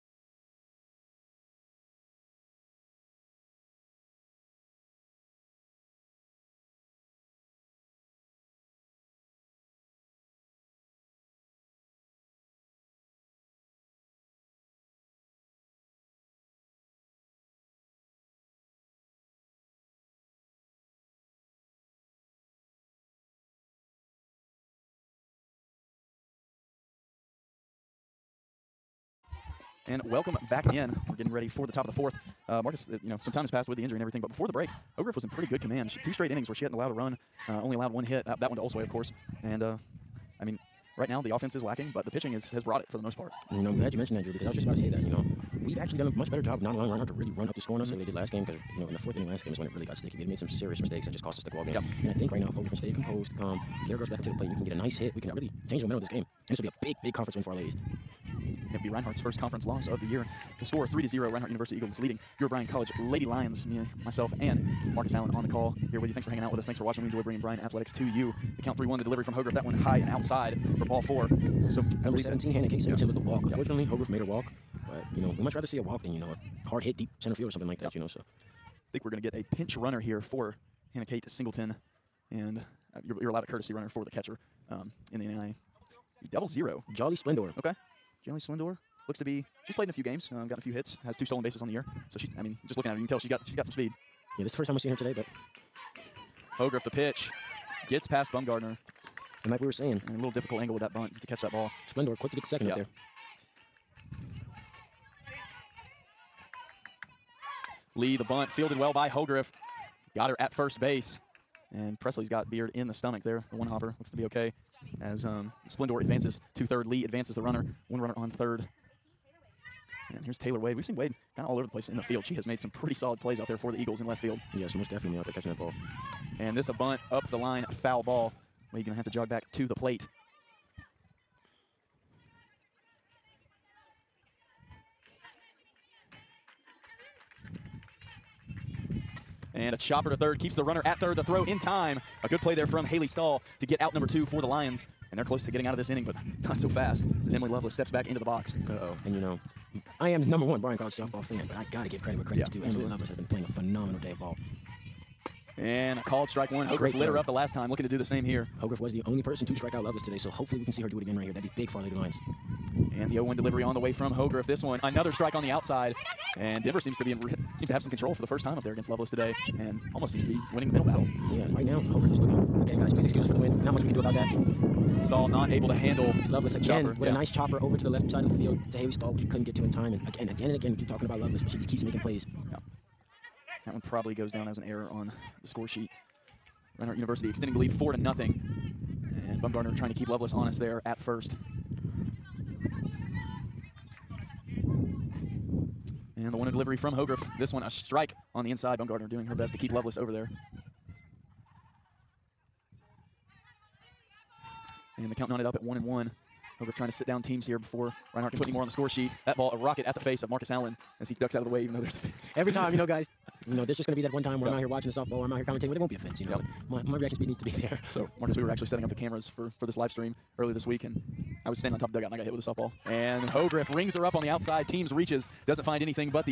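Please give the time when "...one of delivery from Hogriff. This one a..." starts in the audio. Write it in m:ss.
3:16.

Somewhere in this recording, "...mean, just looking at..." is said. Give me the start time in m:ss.
1:32.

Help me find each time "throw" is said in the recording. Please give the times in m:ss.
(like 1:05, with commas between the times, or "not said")
2:21.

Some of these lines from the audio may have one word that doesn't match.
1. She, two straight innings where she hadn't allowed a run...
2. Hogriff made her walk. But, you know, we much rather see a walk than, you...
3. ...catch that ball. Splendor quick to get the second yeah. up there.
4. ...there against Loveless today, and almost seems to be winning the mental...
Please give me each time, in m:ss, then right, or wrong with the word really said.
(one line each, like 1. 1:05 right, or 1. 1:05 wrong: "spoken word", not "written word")
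1. 0:35 right
2. 1:13 right
3. 1:41 right
4. 2:48 right.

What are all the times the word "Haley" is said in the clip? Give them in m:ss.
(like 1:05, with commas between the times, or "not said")
2:22, 2:58.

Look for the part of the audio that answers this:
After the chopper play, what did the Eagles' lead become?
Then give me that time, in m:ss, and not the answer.
3:07.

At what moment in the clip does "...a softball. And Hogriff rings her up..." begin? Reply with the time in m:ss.
3:42.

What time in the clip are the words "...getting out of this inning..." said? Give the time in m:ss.
2:25.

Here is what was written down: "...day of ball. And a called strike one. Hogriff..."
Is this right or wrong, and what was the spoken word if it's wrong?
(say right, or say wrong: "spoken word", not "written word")
right.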